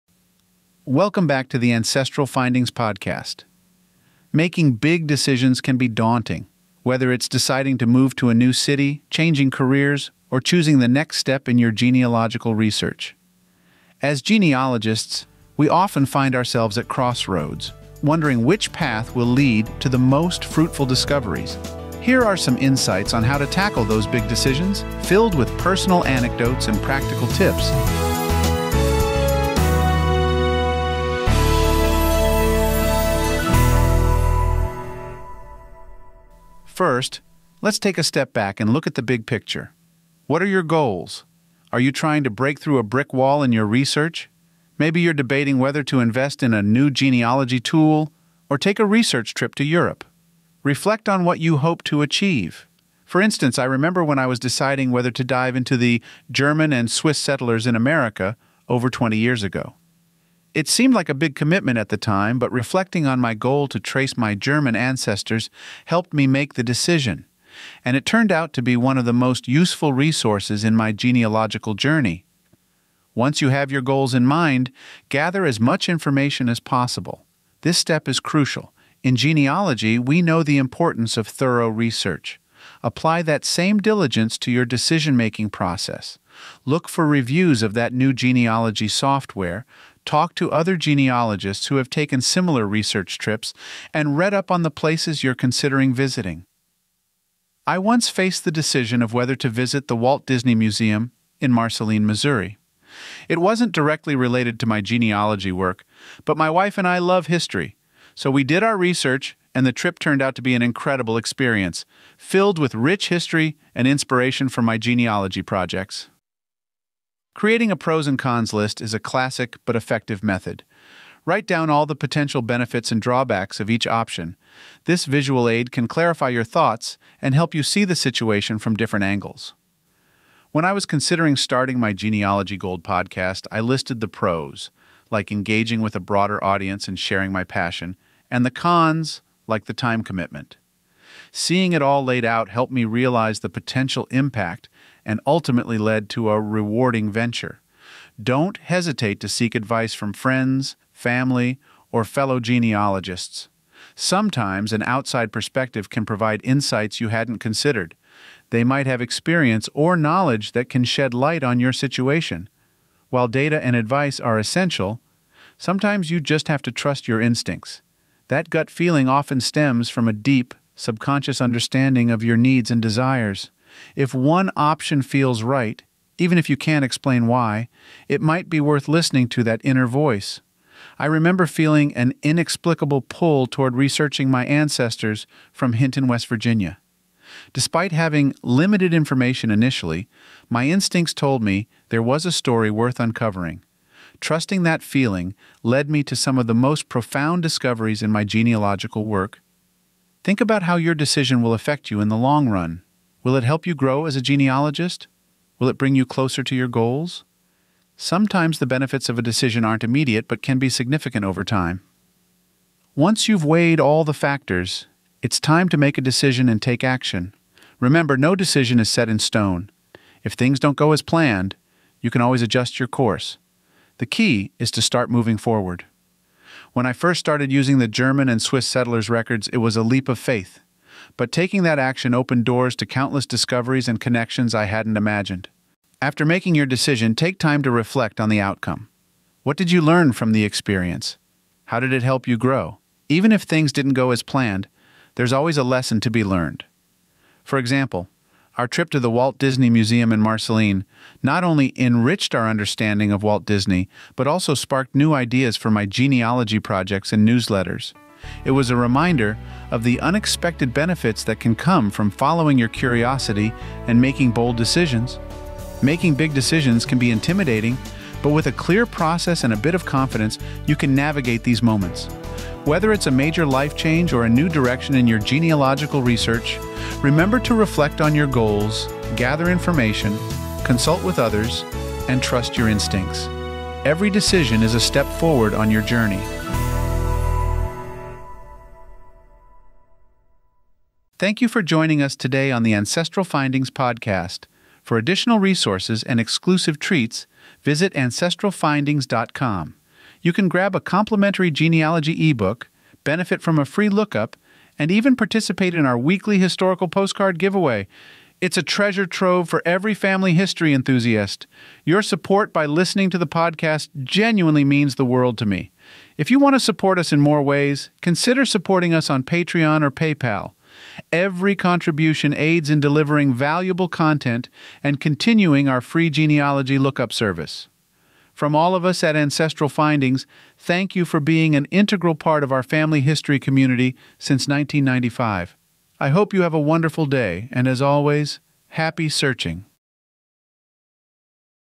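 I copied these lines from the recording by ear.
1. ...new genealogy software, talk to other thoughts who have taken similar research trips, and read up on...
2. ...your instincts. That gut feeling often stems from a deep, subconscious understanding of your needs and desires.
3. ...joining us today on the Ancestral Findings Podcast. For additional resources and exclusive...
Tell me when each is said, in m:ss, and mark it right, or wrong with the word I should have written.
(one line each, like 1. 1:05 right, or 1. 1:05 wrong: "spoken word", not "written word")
1. 1:27 wrong: "genealogists", not "thoughts"
2. 2:47 right
3. 4:51 right.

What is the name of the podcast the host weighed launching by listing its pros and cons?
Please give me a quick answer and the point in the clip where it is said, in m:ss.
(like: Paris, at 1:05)
Genealogy Gold, at 2:11.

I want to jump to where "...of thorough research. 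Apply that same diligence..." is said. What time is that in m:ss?
1:21.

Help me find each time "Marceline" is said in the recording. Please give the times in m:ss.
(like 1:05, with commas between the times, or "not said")
1:41, 4:10.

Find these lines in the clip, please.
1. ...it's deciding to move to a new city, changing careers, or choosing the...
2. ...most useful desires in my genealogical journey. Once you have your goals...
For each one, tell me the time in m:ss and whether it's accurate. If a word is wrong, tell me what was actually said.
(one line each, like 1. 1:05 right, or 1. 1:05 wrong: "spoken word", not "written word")
1. 0:07 right
2. 1:09 wrong: "resources", not "desires".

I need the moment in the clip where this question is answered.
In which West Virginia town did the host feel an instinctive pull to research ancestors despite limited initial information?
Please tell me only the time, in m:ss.
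3:05.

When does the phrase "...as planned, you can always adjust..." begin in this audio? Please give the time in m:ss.
3:40.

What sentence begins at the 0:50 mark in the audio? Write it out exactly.
Reflect on what you hope to achieve.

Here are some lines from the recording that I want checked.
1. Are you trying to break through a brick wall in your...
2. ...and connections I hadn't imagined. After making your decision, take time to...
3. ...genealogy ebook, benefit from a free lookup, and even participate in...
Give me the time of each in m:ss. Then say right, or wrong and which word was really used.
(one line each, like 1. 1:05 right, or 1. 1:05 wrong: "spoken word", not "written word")
1. 0:41 right
2. 3:53 right
3. 5:01 right.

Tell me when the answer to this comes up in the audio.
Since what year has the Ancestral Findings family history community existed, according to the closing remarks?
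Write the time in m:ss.
5:34.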